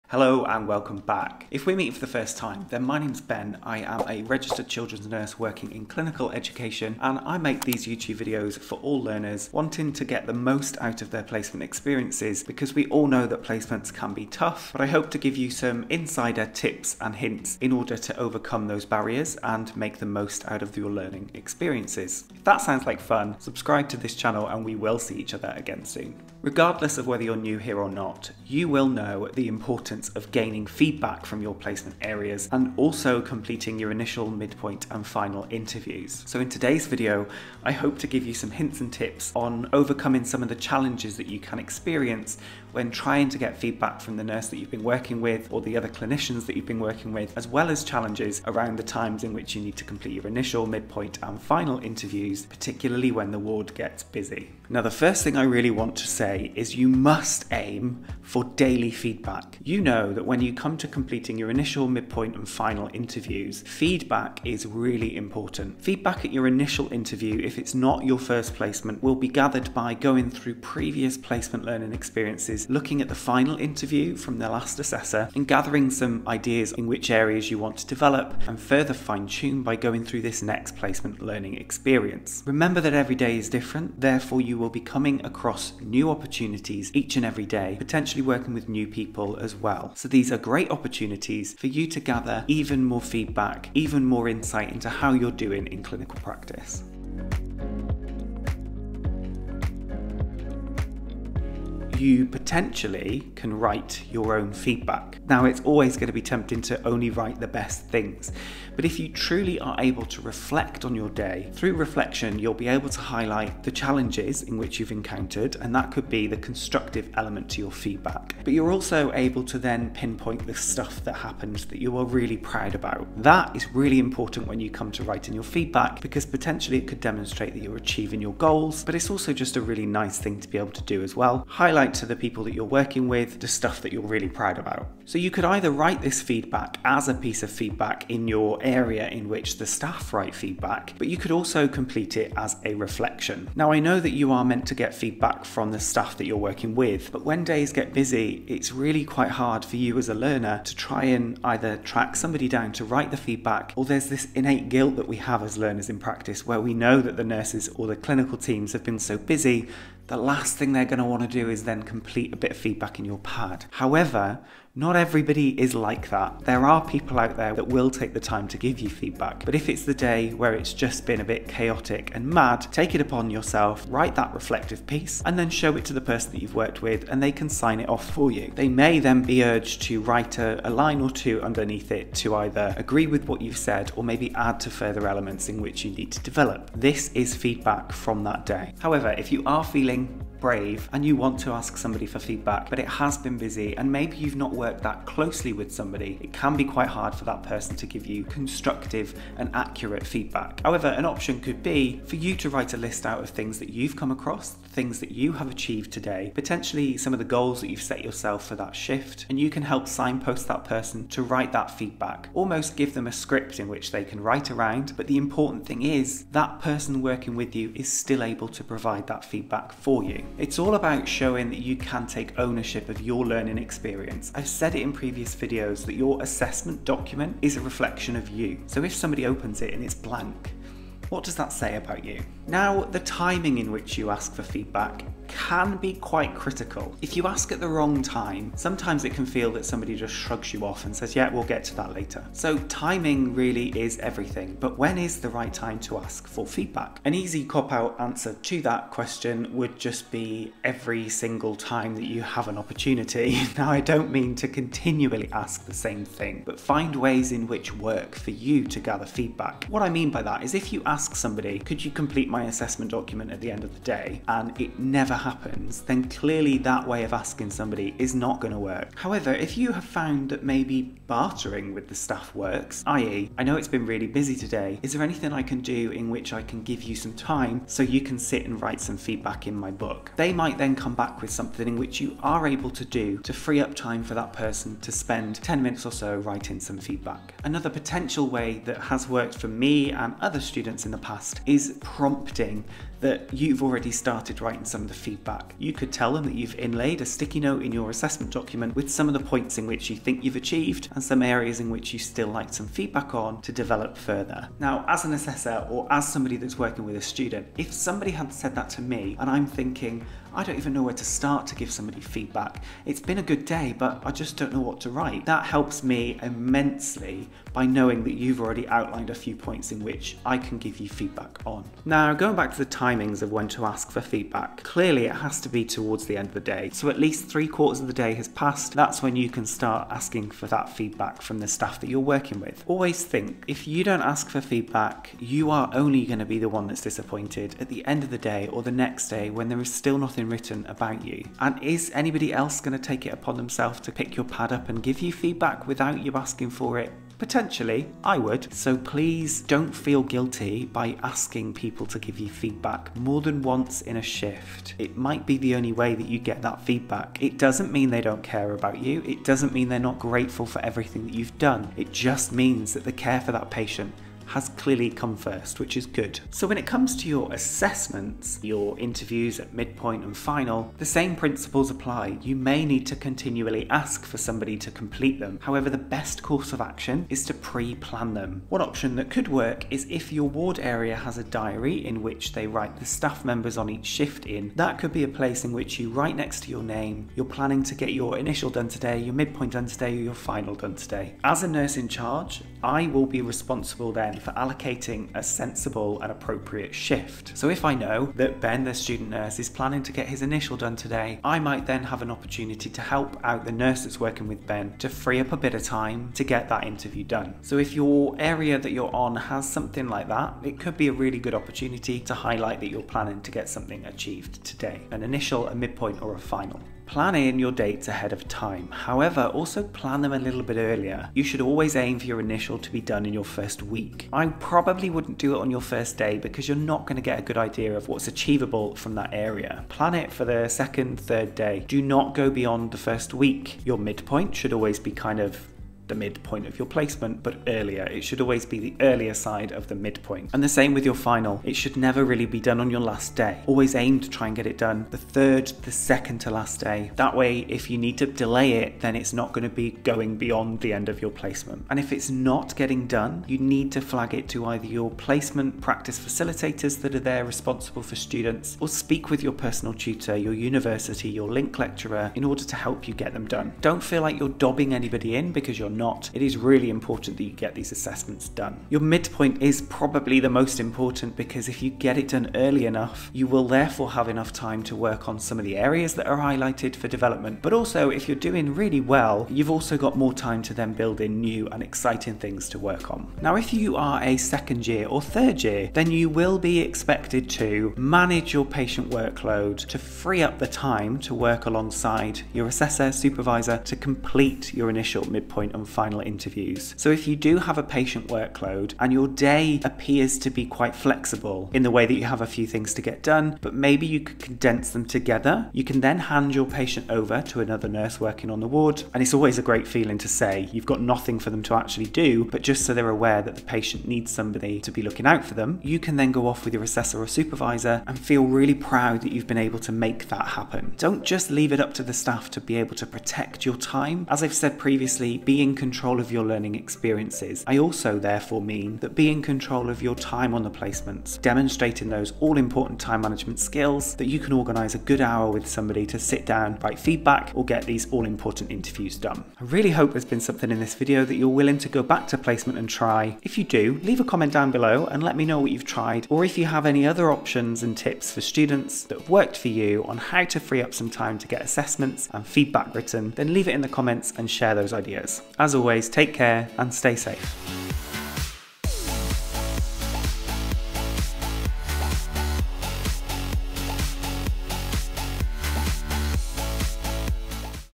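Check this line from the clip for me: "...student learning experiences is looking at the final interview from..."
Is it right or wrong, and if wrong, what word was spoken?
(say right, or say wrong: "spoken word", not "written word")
wrong: "placement", not "student".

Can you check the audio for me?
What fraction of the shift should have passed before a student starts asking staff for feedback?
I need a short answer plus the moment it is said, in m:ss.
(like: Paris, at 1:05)
Three quarters, at 5:27.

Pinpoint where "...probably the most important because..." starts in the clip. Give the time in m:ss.
7:49.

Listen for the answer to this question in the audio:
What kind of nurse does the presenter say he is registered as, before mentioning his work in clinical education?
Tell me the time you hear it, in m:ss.
0:04.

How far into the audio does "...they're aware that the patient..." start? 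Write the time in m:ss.
8:32.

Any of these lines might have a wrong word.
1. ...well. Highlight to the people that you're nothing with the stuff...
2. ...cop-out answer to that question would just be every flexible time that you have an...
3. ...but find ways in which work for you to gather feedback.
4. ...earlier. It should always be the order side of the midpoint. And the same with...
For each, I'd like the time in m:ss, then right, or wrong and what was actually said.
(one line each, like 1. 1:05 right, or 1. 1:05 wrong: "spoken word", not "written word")
1. 2:11 wrong: "working", not "nothing"
2. 4:07 wrong: "single", not "flexible"
3. 4:16 right
4. 7:17 wrong: "earlier", not "order".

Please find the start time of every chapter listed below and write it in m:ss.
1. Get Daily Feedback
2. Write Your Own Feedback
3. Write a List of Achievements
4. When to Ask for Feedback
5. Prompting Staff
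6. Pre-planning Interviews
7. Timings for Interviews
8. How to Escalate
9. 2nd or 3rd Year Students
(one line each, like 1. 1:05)
1. 0:54
2. 1:42
3. 3:08
4. 3:53
5. 4:47
6. 6:07
7. 7:01
8. 7:31
9. 8:03.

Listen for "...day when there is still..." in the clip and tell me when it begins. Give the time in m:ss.
5:39.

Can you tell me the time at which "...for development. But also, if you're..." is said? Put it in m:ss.
7:56.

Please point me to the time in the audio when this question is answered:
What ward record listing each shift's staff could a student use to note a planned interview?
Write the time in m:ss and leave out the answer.
6:21.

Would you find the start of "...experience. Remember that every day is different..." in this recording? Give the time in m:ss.
1:21.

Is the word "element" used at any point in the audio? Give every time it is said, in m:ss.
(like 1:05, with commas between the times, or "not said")
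1:57, 3:05.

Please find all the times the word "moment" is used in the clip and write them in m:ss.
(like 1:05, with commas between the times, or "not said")
not said.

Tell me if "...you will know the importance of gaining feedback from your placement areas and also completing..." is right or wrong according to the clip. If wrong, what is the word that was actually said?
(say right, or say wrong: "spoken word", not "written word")
right.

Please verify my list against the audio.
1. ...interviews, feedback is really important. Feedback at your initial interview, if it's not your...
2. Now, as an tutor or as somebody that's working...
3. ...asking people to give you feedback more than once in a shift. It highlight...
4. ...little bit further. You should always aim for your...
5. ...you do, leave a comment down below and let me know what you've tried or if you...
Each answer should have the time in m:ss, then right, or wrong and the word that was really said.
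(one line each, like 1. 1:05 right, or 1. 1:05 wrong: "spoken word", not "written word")
1. 1:02 right
2. 5:04 wrong: "assessor", not "tutor"
3. 5:51 wrong: "might", not "highlight"
4. 7:00 wrong: "earlier", not "further"
5. 9:03 right.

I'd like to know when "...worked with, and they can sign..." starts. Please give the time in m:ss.
2:56.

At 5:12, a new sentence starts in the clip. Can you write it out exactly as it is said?
It's been a good day, but I just don't know what to write.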